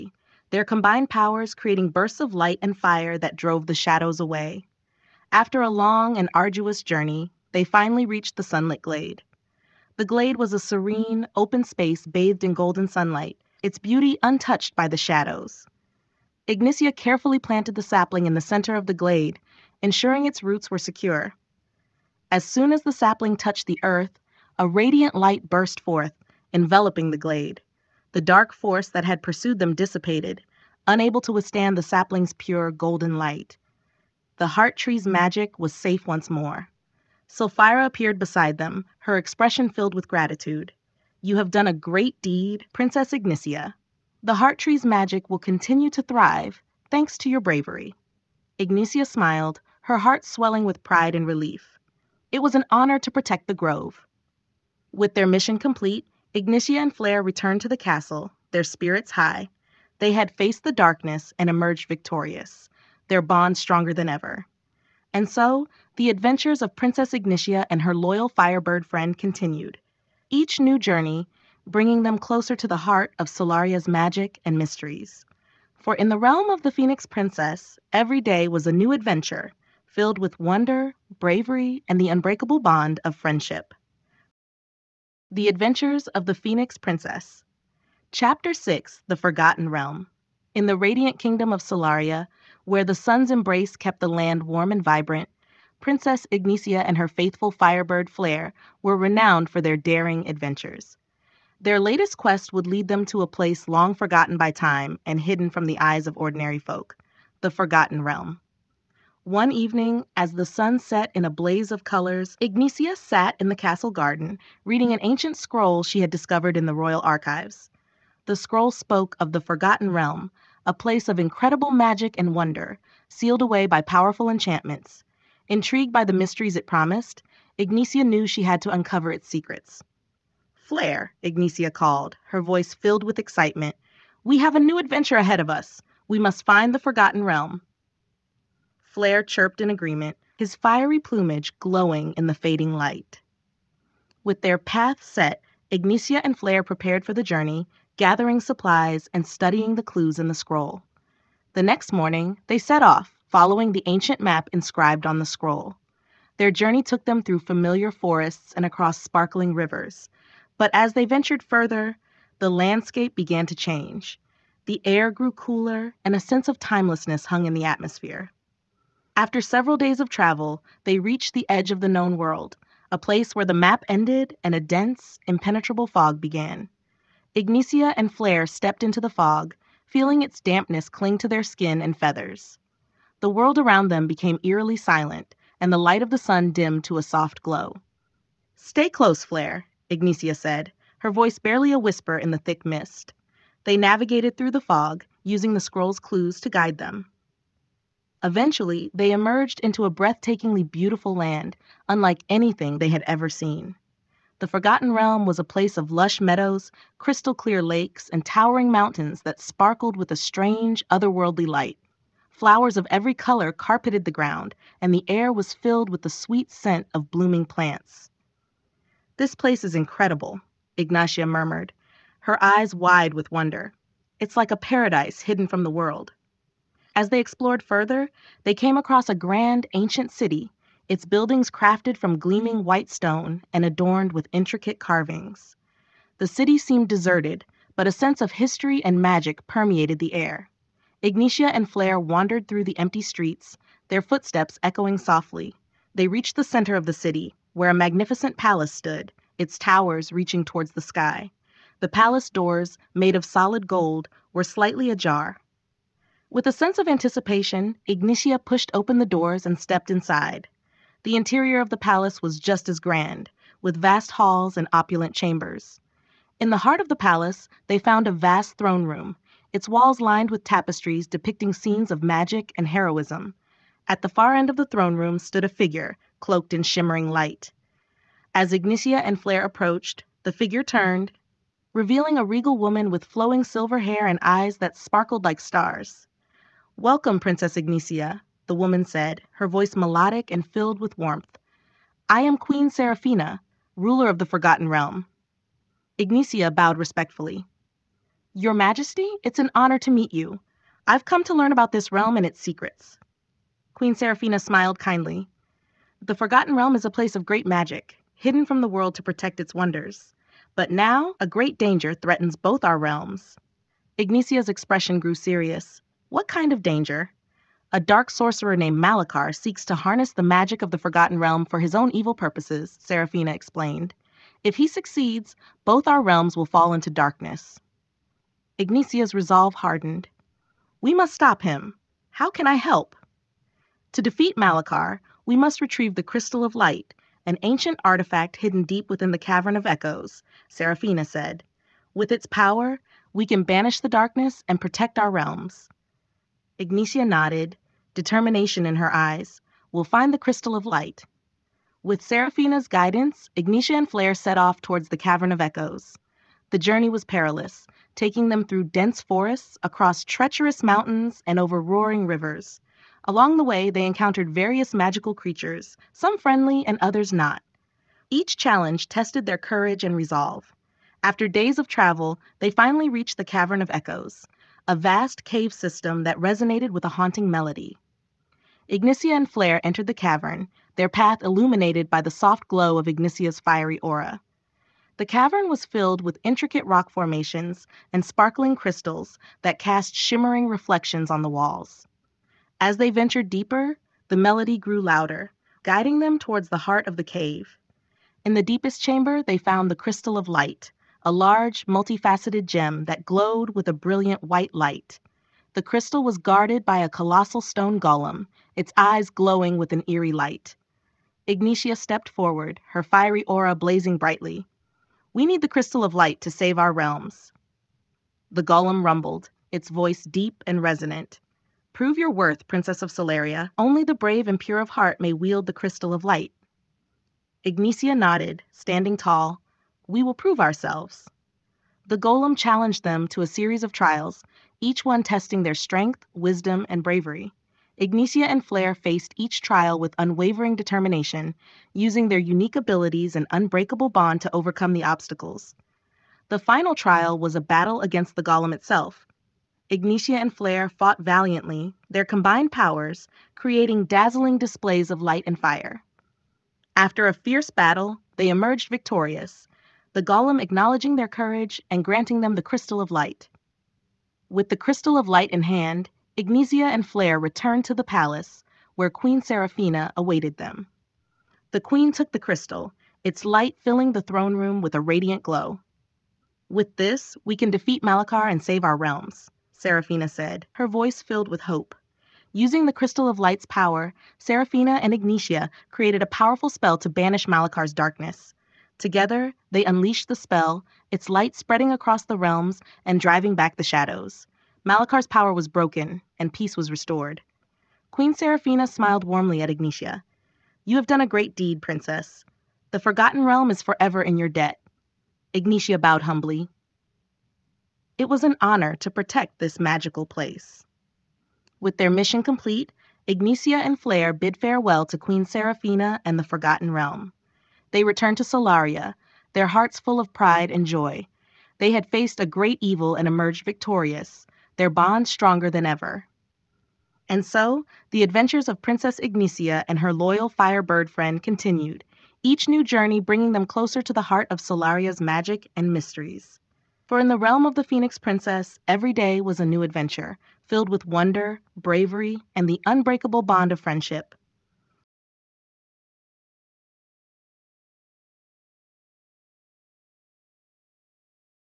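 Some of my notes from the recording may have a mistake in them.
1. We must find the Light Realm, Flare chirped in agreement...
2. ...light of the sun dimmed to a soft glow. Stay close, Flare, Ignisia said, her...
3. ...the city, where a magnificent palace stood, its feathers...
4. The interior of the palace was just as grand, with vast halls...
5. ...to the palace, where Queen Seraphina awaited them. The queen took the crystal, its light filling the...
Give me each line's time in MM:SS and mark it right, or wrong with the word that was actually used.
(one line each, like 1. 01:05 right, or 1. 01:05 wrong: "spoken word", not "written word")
1. 02:16 wrong: "Forgotten", not "Light"
2. 03:05 right
3. 04:06 wrong: "towers", not "feathers"
4. 04:21 right
5. 07:47 right.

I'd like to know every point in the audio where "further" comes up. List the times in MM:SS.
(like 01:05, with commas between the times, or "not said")
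02:41, 03:47.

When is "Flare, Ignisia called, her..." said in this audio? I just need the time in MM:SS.
02:10.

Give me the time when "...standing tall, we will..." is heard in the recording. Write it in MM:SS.
07:08.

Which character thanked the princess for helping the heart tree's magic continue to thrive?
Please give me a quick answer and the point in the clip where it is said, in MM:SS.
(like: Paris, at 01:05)
Sylphira, at 00:37.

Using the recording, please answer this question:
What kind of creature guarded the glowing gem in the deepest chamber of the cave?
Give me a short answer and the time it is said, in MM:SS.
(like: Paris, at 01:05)
stone golem, at 06:47.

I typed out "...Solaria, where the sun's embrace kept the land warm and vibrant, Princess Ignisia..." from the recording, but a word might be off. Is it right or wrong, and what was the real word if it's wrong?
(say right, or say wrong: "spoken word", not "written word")
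right.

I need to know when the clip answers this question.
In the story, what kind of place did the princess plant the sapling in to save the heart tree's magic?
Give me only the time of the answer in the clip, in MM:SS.
00:08.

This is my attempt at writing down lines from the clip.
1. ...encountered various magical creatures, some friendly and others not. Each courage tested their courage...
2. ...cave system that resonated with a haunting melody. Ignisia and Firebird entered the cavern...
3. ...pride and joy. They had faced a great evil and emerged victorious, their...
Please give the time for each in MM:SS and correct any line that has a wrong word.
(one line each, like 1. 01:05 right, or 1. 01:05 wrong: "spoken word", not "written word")
1. 06:03 wrong: "challenge", not "courage"
2. 06:15 wrong: "Flare", not "Firebird"
3. 08:40 right.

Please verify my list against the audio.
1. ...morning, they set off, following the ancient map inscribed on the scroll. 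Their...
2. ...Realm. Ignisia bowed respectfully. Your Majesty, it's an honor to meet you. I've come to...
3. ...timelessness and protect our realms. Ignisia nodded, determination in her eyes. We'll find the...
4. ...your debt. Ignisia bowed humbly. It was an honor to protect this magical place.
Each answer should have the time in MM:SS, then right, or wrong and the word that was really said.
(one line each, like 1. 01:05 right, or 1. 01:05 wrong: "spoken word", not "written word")
1. 02:31 right
2. 04:54 right
3. 05:43 wrong: "darkness", not "timelessness"
4. 08:24 right.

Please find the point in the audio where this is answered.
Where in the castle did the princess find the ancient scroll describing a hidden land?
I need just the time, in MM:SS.
01:56.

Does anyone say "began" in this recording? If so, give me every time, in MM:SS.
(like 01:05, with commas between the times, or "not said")
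02:43, 02:56.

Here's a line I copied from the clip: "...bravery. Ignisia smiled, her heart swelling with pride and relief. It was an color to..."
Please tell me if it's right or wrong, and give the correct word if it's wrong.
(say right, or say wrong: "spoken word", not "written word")
wrong: "honor", not "color".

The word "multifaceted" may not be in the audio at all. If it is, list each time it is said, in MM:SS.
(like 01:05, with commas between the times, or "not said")
06:41.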